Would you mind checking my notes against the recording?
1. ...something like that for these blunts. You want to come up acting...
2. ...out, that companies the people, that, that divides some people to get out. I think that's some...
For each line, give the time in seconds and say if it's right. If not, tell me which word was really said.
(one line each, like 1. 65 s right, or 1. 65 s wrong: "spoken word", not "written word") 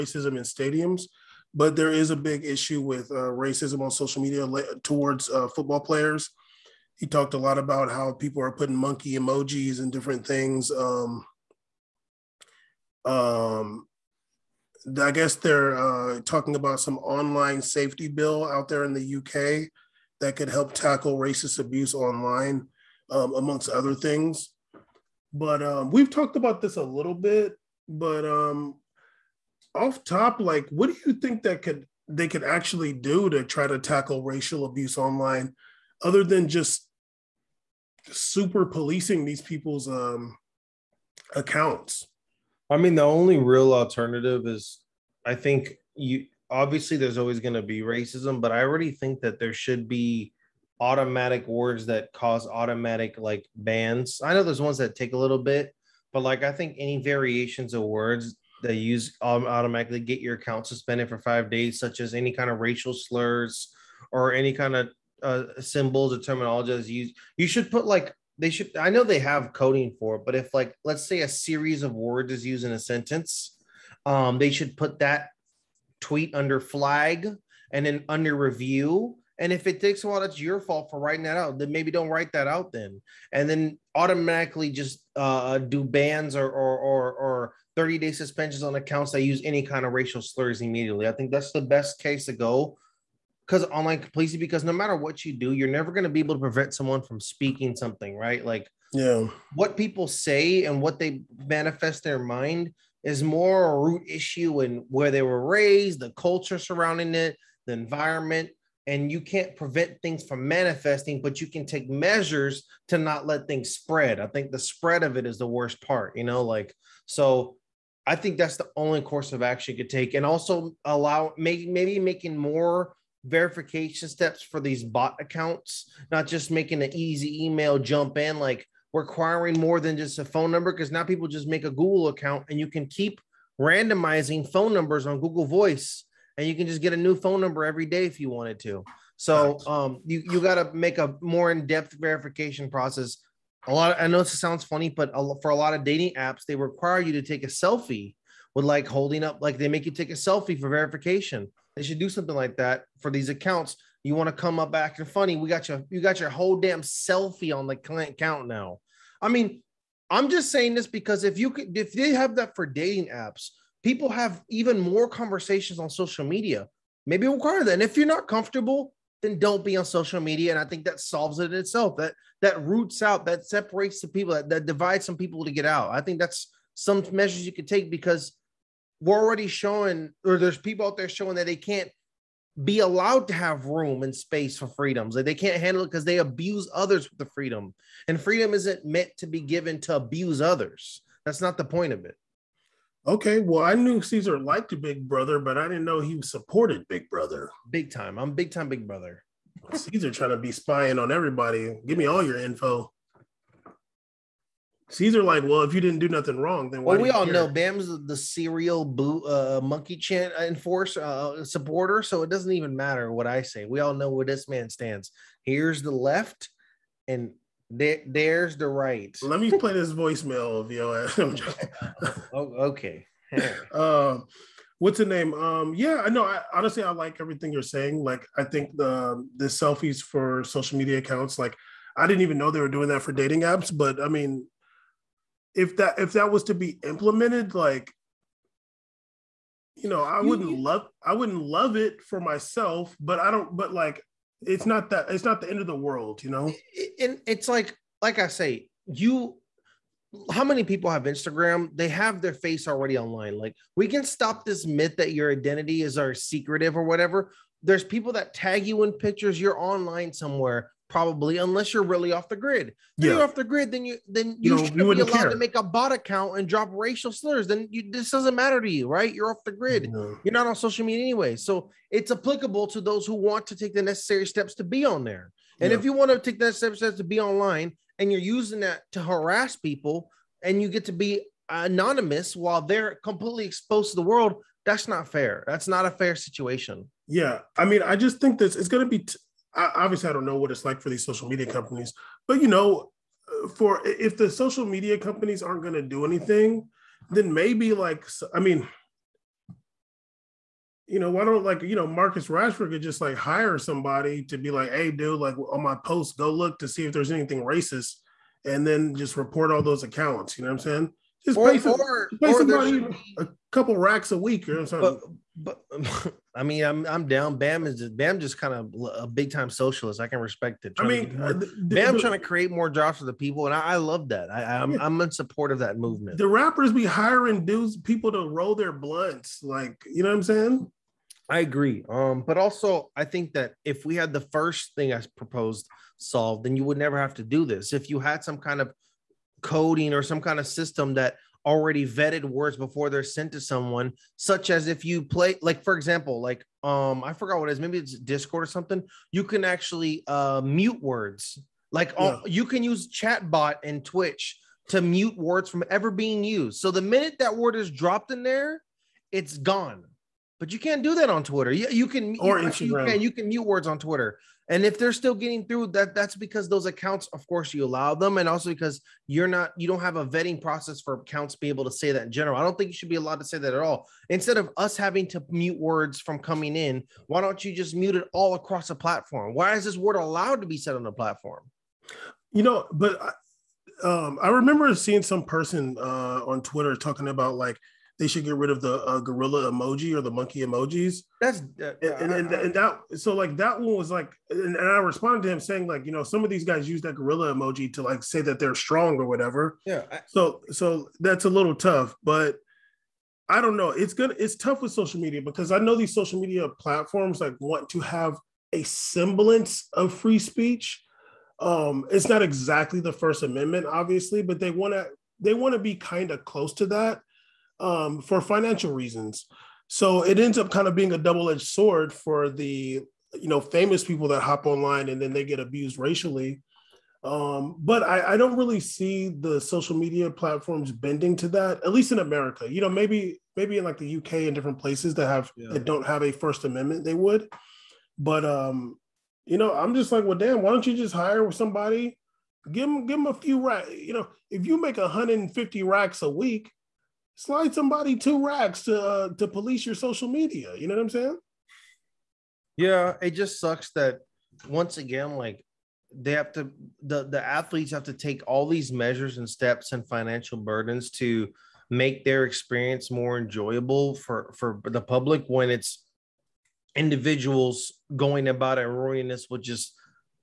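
1. 152 s wrong: "accounts", not "blunts"
2. 173 s wrong: "separates", not "companies".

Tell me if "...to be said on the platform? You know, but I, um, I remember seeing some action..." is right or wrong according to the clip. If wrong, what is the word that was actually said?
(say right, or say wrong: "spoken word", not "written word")
wrong: "person", not "action".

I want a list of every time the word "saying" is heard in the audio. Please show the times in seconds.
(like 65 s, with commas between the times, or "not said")
160 s, 227 s, 310 s, 330 s, 395 s, 450 s.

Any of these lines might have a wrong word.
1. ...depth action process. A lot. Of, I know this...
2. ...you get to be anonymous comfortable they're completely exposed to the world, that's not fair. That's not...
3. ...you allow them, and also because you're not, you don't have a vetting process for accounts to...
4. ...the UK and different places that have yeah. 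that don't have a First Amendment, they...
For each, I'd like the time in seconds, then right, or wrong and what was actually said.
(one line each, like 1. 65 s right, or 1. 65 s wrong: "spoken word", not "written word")
1. 141 s wrong: "verification", not "action"
2. 280 s wrong: "while", not "comfortable"
3. 367 s right
4. 433 s right.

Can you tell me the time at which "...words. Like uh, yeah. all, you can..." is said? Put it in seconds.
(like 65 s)
350 s.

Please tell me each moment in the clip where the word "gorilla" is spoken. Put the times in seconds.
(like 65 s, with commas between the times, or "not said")
389 s, 396 s.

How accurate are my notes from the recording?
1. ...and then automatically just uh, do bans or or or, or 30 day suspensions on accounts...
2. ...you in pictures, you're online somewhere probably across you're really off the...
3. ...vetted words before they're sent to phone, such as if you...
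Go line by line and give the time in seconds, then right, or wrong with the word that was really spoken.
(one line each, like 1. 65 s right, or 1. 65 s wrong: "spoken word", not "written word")
1. 83 s right
2. 258 s wrong: "unless", not "across"
3. 341 s wrong: "someone", not "phone".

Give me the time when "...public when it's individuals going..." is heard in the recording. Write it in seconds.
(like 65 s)
464 s.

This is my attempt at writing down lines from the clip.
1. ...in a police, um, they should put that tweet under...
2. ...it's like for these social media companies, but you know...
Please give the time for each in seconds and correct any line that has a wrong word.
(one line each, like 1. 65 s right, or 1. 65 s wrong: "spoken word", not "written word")
1. 72 s wrong: "sentence", not "police"
2. 290 s right.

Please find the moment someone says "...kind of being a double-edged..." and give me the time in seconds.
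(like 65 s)
420 s.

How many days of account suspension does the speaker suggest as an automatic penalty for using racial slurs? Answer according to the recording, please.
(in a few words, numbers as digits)
5.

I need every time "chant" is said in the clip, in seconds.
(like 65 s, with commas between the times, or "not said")
209 s.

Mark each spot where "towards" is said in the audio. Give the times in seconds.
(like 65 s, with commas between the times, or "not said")
4 s.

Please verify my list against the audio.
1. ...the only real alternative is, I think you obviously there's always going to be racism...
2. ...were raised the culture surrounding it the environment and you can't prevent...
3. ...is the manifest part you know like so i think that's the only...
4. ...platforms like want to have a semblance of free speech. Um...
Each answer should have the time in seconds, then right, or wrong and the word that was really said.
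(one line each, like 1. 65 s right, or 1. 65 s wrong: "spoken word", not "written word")
1. 42 s right
2. 105 s right
3. 115 s wrong: "worst", not "manifest"
4. 406 s right.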